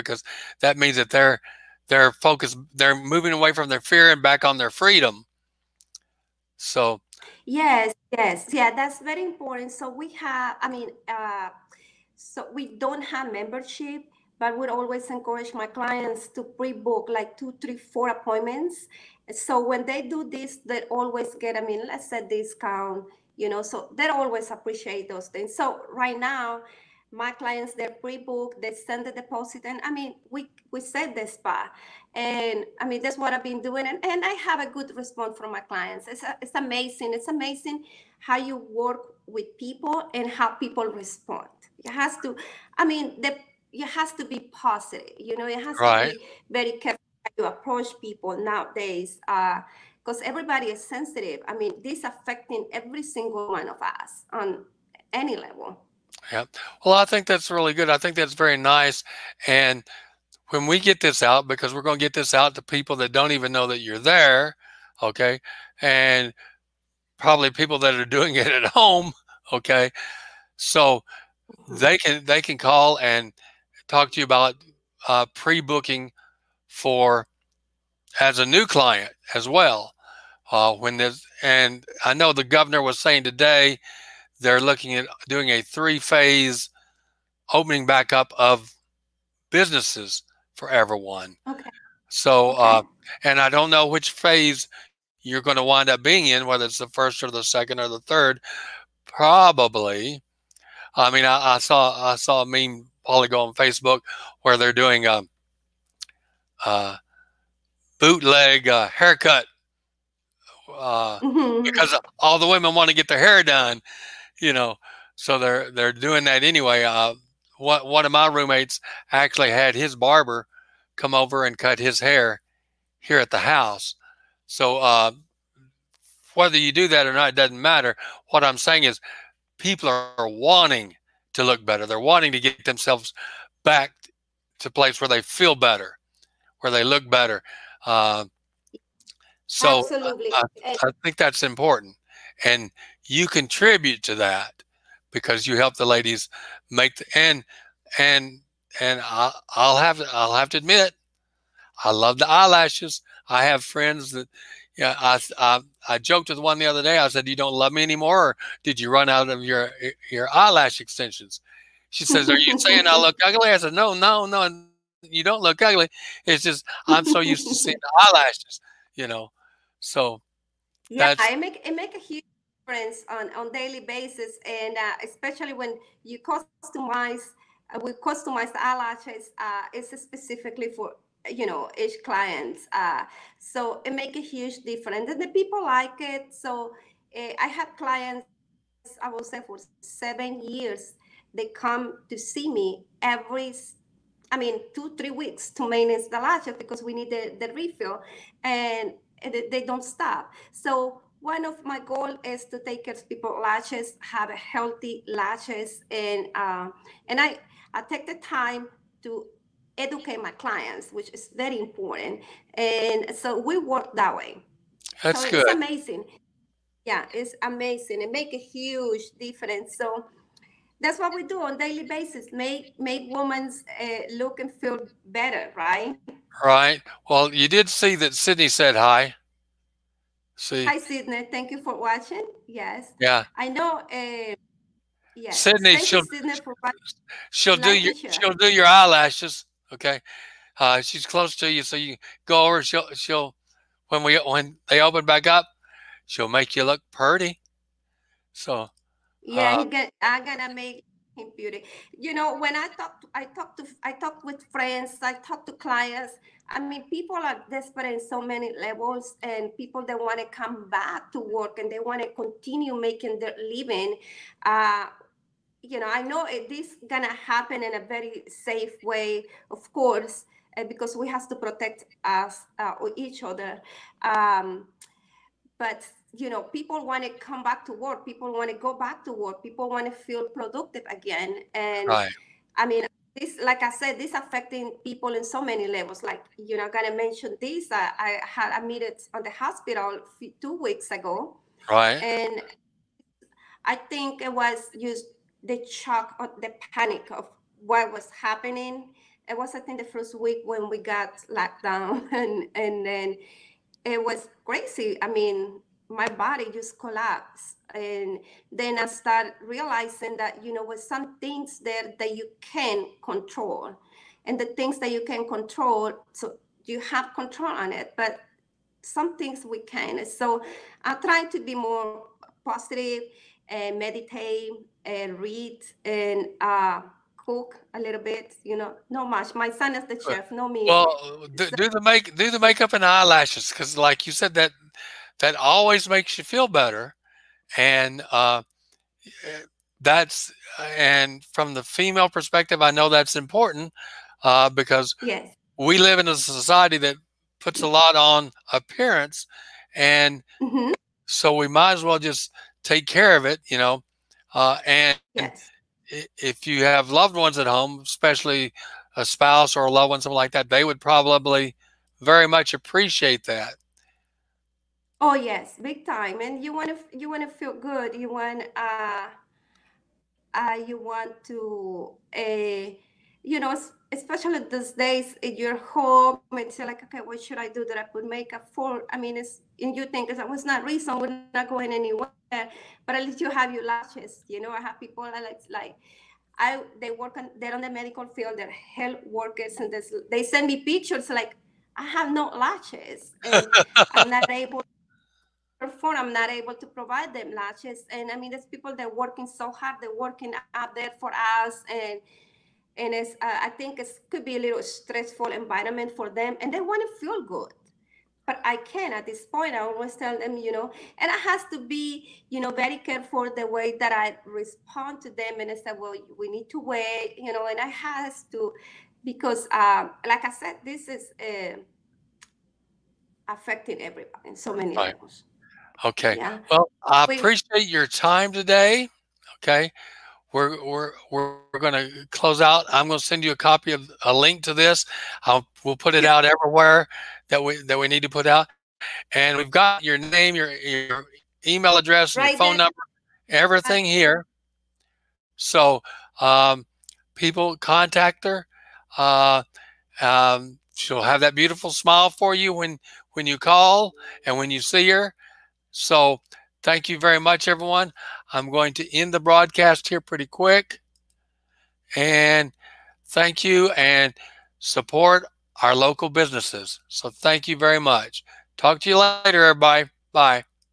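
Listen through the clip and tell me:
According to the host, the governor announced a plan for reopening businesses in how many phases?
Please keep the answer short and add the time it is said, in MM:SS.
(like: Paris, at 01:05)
3, at 01:25.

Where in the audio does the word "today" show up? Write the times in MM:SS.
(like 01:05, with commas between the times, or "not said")
01:23, 07:08.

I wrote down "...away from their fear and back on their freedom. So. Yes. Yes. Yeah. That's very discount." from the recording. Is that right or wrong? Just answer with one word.
wrong.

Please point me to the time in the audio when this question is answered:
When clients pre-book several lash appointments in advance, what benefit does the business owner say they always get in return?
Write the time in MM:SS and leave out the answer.
00:22.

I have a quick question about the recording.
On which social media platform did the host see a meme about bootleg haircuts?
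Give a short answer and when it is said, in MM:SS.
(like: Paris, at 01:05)
Facebook, at 01:43.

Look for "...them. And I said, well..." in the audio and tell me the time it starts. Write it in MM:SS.
06:55.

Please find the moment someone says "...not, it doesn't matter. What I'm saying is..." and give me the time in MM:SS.
02:07.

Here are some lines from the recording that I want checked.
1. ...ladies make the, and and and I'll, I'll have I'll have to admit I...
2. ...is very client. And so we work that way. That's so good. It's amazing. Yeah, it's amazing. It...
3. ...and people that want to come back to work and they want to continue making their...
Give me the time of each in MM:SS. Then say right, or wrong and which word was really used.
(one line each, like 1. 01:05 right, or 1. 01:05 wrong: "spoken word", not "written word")
1. 02:25 right
2. 03:31 wrong: "important", not "client"
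3. 04:19 right.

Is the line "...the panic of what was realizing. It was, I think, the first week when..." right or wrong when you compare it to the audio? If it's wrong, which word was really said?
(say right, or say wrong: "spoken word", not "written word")
wrong: "happening", not "realizing".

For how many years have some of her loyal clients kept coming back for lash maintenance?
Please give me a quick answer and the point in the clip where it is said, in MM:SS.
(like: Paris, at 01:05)
7, at 03:09.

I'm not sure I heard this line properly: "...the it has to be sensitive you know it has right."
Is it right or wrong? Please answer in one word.
wrong.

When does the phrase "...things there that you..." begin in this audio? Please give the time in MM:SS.
05:11.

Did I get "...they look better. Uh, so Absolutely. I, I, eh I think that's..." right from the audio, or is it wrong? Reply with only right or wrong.
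right.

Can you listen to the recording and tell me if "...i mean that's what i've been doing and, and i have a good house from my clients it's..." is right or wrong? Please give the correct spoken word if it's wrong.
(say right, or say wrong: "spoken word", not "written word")
wrong: "response", not "house".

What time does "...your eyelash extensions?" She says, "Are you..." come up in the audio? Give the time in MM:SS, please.
02:40.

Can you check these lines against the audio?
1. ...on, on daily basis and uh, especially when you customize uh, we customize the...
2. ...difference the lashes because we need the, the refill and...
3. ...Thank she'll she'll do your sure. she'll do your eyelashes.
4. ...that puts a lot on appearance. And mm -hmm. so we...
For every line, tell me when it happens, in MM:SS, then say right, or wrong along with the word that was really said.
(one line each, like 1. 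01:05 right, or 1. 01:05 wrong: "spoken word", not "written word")
1. 02:53 right
2. 03:15 wrong: "maintenance", not "difference"
3. 03:55 right
4. 05:46 right.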